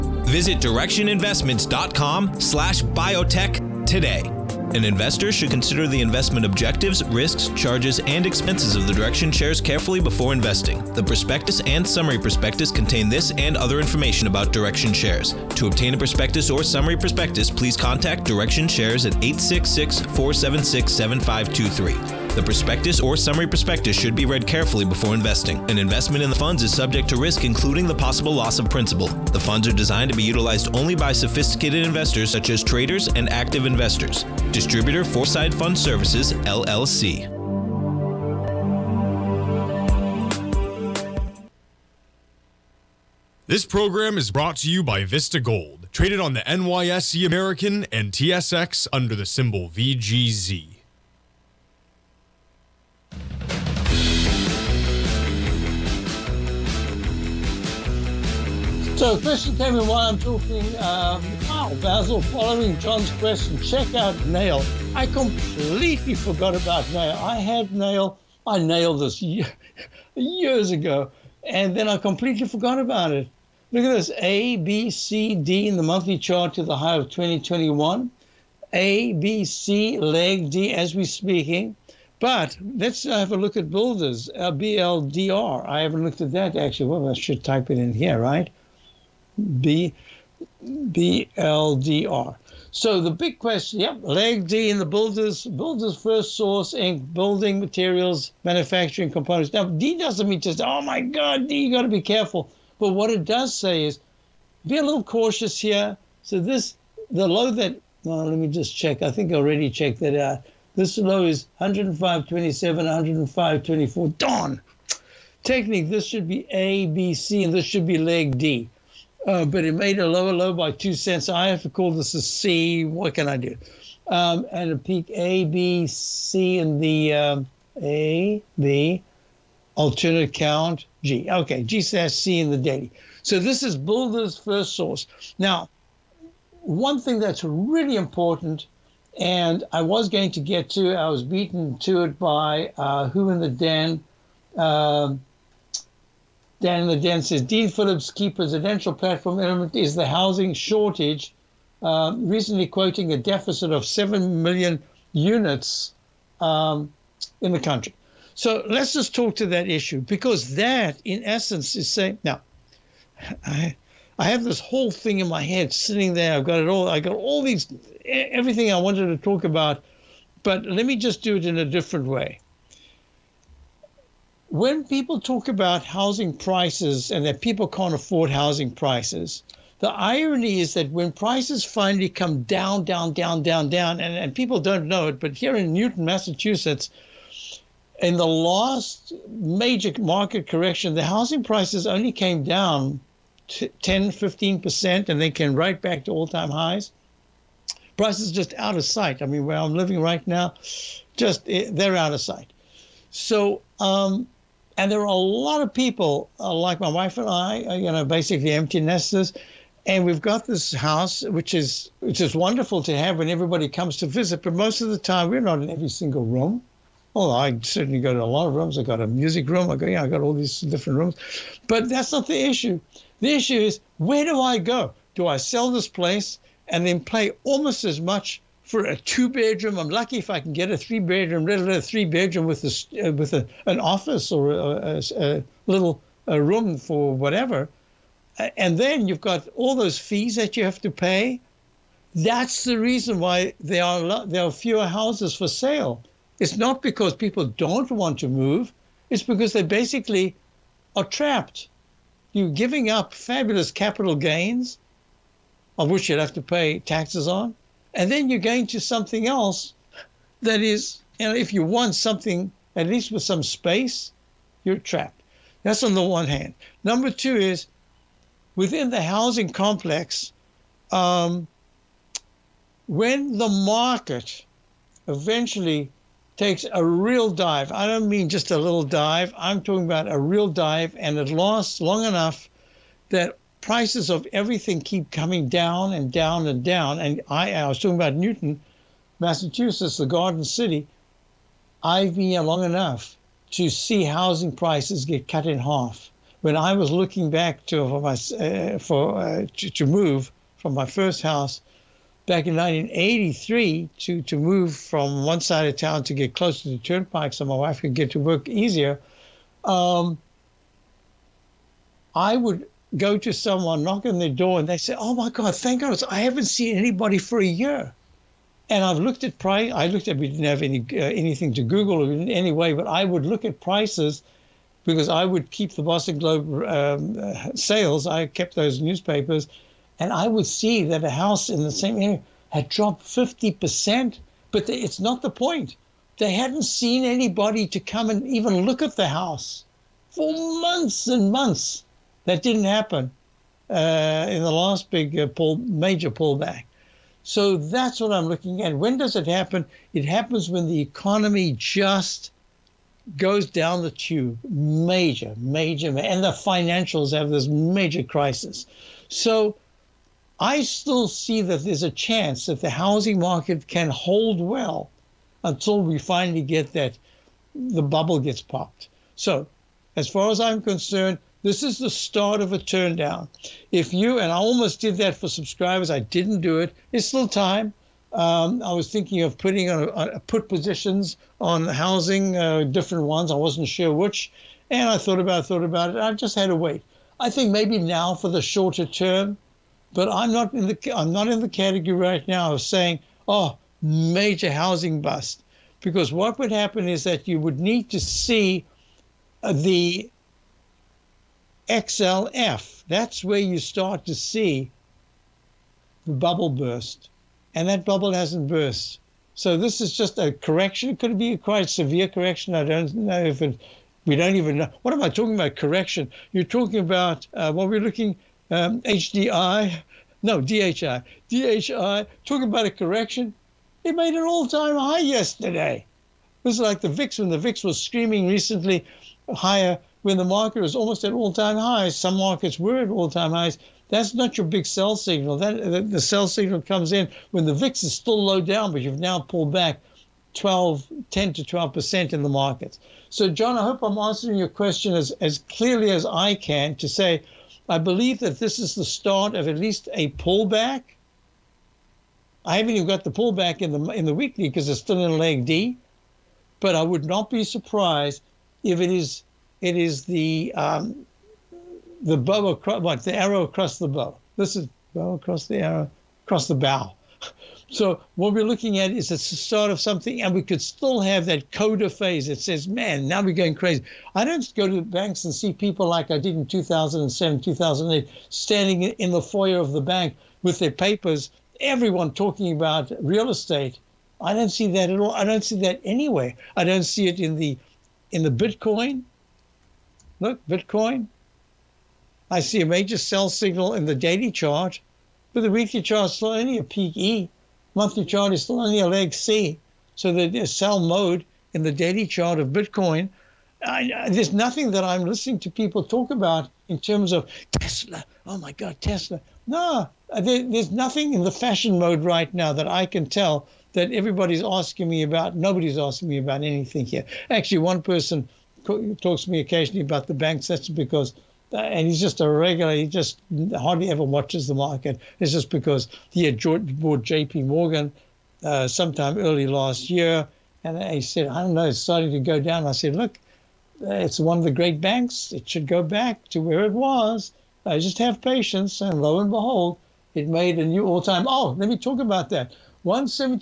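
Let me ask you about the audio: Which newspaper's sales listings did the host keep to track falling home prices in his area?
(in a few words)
The Boston Globe.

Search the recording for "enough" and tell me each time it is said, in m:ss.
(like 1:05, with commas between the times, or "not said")
4:42, 4:52.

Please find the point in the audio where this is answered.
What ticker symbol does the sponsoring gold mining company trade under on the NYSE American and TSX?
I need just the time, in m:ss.
0:49.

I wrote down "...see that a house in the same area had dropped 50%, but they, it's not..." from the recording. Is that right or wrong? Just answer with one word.
right.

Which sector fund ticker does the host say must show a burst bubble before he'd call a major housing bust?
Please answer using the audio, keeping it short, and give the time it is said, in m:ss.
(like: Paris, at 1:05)
XLF, at 6:41.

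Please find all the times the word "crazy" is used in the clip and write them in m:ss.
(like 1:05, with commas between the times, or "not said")
7:53.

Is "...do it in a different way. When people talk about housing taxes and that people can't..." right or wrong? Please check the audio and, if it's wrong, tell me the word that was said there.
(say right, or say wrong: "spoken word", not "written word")
wrong: "prices", not "taxes".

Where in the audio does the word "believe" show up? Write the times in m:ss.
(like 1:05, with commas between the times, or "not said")
7:27.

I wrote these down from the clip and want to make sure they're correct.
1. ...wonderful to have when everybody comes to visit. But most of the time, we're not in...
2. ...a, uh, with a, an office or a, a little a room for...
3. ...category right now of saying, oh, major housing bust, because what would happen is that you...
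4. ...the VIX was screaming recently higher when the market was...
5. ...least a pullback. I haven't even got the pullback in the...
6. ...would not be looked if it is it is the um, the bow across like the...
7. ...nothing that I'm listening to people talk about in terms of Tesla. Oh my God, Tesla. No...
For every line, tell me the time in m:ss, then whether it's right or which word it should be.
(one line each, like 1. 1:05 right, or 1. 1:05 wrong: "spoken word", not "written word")
1. 3:32 right
2. 3:52 right
3. 6:31 right
4. 7:07 right
5. 7:29 right
6. 7:36 wrong: "surprised", not "looked"
7. 8:24 right.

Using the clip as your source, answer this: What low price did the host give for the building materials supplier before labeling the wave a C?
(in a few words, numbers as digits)
105.24.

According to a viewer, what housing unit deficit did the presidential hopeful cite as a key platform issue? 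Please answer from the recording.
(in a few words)
7 million units.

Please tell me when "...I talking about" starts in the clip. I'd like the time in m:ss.
6:55.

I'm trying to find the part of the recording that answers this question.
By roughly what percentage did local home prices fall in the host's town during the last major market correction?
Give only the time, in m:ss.
3:13.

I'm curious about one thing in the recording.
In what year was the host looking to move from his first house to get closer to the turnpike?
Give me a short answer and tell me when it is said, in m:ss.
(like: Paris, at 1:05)
1983, at 5:02.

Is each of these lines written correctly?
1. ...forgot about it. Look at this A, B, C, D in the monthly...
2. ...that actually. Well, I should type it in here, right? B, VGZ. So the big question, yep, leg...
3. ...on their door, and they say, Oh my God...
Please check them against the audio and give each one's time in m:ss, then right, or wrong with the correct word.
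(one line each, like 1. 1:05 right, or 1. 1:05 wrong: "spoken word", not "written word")
1. 1:12 right
2. 1:26 wrong: "BLDR", not "VGZ"
3. 5:14 right.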